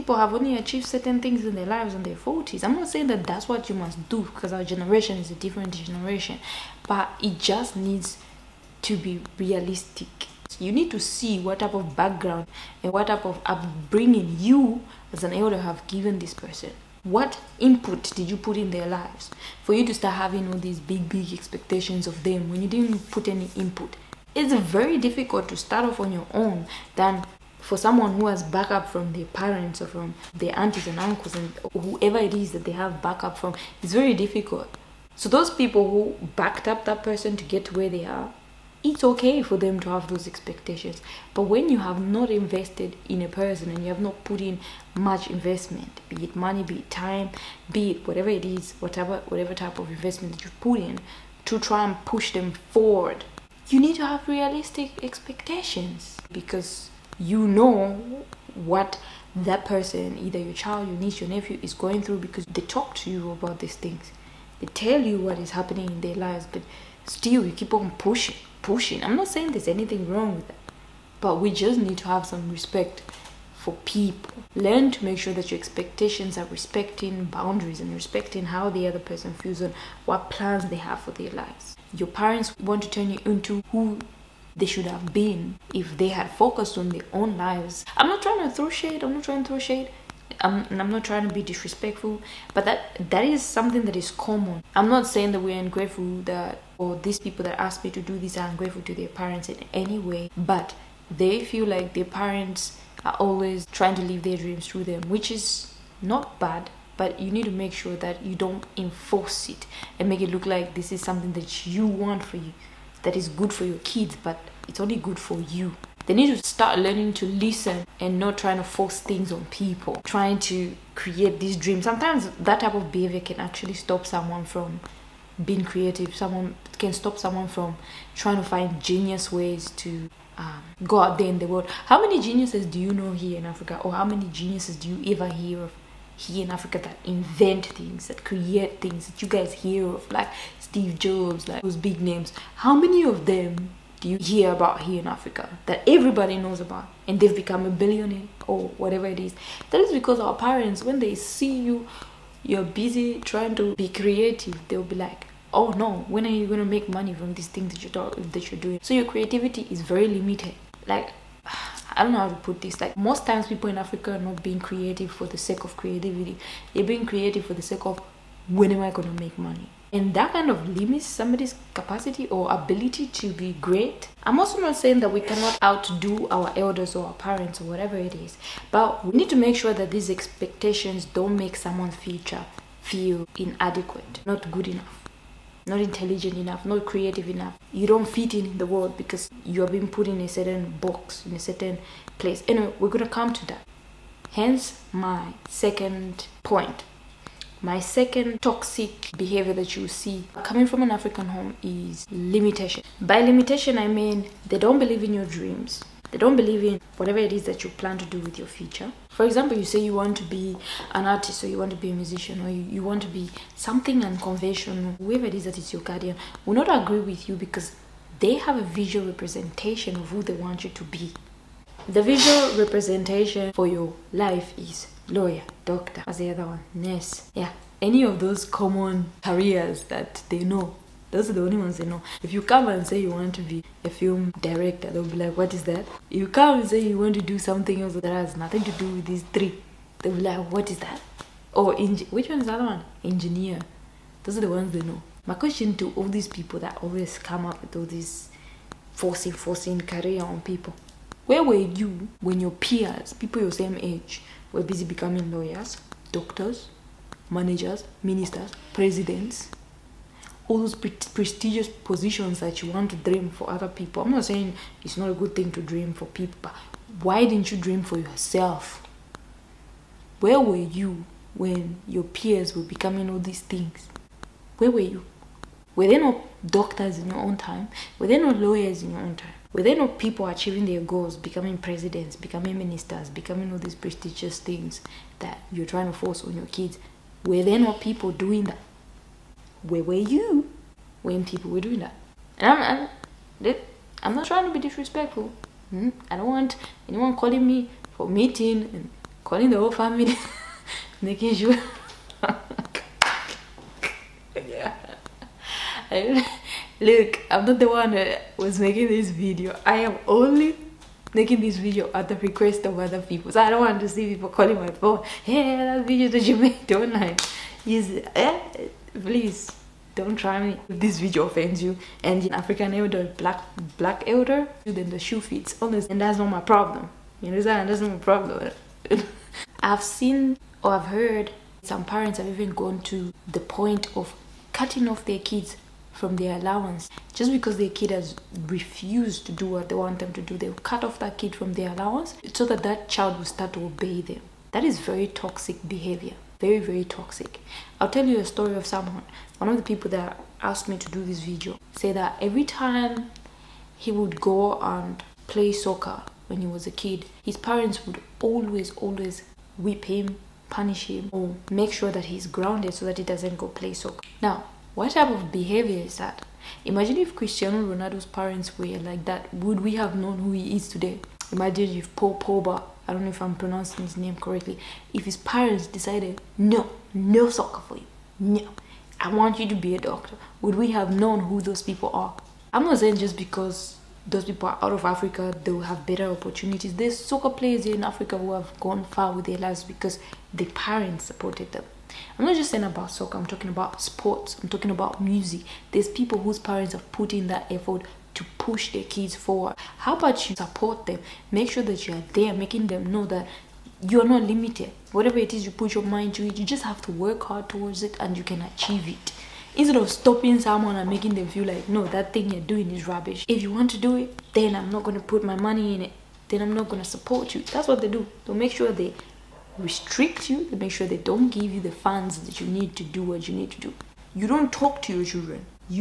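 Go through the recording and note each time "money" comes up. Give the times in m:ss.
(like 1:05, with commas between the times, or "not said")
0:46, 2:36, 2:49, 6:55.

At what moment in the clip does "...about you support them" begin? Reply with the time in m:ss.
6:39.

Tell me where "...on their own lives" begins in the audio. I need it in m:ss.
1:26.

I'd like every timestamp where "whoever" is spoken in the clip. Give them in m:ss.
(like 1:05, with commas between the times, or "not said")
0:31, 3:34.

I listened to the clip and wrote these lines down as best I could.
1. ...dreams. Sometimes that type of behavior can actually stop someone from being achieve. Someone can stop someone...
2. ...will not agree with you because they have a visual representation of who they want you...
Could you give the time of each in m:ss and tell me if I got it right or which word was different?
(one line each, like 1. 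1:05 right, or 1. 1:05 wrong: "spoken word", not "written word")
1. 2:01 wrong: "creative", not "achieve"
2. 3:36 right.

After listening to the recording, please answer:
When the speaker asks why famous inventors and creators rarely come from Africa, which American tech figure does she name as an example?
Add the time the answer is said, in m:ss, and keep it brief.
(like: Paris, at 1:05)
Steve Jobs, at 2:20.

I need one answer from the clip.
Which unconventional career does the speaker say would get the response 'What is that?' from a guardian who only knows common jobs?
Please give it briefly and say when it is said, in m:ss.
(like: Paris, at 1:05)
Film director, at 3:53.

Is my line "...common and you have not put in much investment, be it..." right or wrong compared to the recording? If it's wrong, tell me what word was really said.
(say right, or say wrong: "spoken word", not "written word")
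wrong: "person", not "common".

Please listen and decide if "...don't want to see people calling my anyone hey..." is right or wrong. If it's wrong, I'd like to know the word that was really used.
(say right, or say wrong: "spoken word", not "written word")
wrong: "phone", not "anyone".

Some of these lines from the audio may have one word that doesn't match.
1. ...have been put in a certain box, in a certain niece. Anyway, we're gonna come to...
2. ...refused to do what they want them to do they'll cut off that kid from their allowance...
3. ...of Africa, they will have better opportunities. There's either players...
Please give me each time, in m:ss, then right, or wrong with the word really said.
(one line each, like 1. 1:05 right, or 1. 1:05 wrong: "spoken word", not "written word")
1. 3:09 wrong: "place", not "niece"
2. 5:38 right
3. 6:24 wrong: "soccer", not "either".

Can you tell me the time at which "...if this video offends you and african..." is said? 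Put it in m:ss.
5:20.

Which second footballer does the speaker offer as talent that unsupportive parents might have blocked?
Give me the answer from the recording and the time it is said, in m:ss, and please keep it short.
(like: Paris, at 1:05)
Paul Pogba, at 6:11.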